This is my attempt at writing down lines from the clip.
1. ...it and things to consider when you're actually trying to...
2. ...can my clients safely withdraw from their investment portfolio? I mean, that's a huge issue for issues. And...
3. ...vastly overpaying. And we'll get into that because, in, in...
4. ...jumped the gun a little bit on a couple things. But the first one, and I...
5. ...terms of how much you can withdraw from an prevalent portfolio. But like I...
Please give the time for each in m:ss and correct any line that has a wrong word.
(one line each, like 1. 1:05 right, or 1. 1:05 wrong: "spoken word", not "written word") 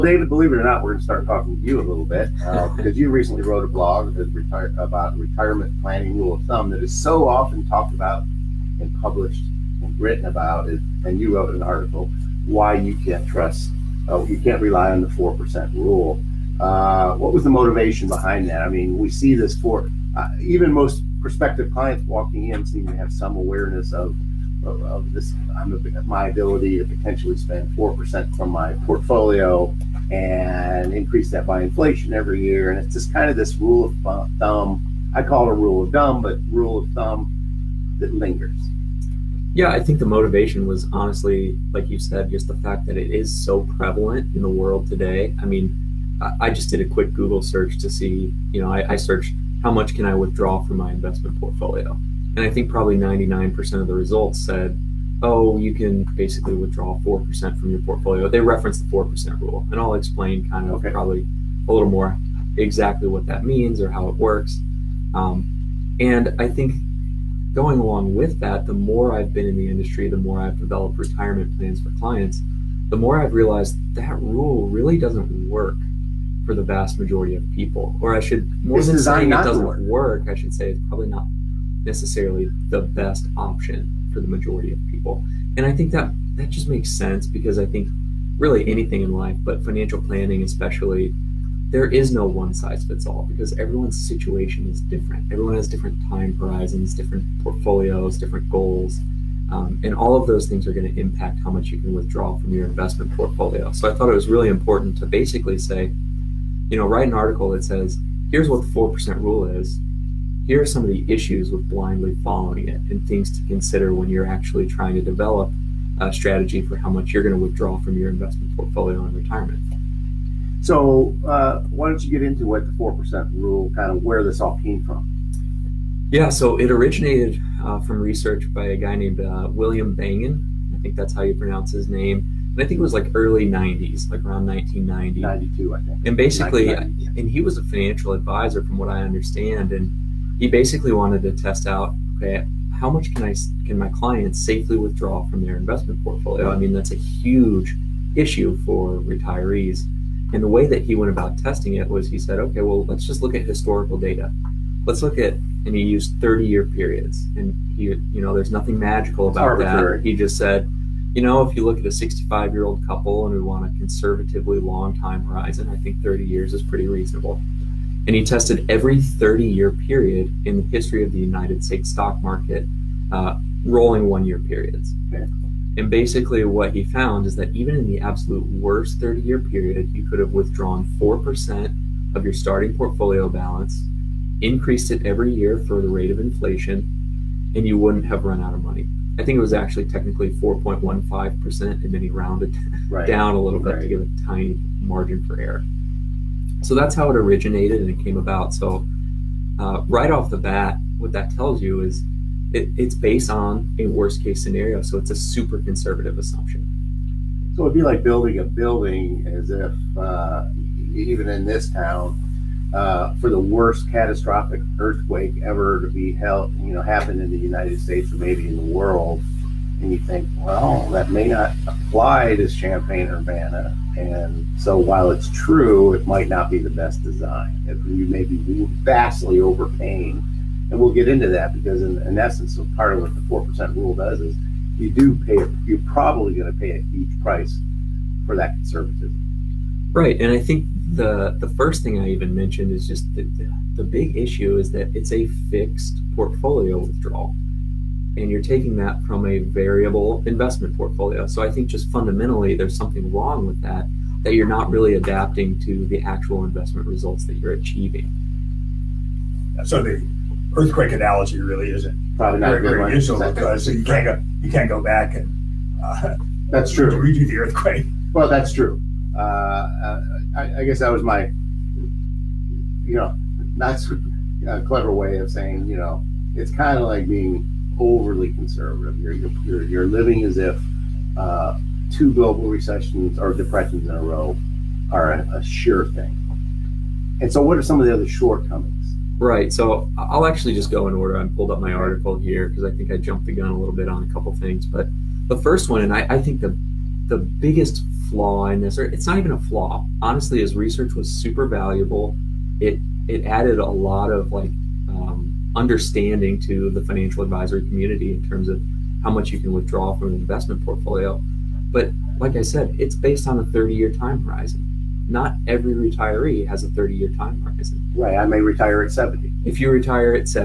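1. 1:52 right
2. 2:23 wrong: "retirees", not "issues"
3. 3:48 right
4. 4:52 right
5. 5:08 wrong: "investment", not "prevalent".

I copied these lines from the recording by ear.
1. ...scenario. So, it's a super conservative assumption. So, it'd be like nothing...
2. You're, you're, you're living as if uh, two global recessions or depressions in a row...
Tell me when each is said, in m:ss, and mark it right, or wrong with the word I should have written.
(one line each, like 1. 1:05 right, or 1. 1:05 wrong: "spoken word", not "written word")
1. 3:24 wrong: "building", not "nothing"
2. 4:38 right.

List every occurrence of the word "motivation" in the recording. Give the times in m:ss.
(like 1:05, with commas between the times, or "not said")
0:17, 0:40.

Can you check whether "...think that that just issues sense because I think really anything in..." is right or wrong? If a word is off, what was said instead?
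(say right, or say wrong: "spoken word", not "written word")
wrong: "makes", not "issues".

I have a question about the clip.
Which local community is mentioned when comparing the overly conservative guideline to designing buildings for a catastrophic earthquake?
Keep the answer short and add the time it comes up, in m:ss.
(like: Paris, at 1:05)
Champaign Urbana, at 3:42.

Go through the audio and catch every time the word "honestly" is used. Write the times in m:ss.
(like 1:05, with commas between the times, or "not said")
0:40, 5:00.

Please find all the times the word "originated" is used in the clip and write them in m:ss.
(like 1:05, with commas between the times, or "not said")
2:06, 3:17.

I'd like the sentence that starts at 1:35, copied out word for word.
Everyone has different time horizons, different portfolios, different goals.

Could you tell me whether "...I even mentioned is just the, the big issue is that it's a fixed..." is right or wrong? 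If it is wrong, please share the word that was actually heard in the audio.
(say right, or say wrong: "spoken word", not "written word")
right.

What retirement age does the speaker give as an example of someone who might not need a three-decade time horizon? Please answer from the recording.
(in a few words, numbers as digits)
70.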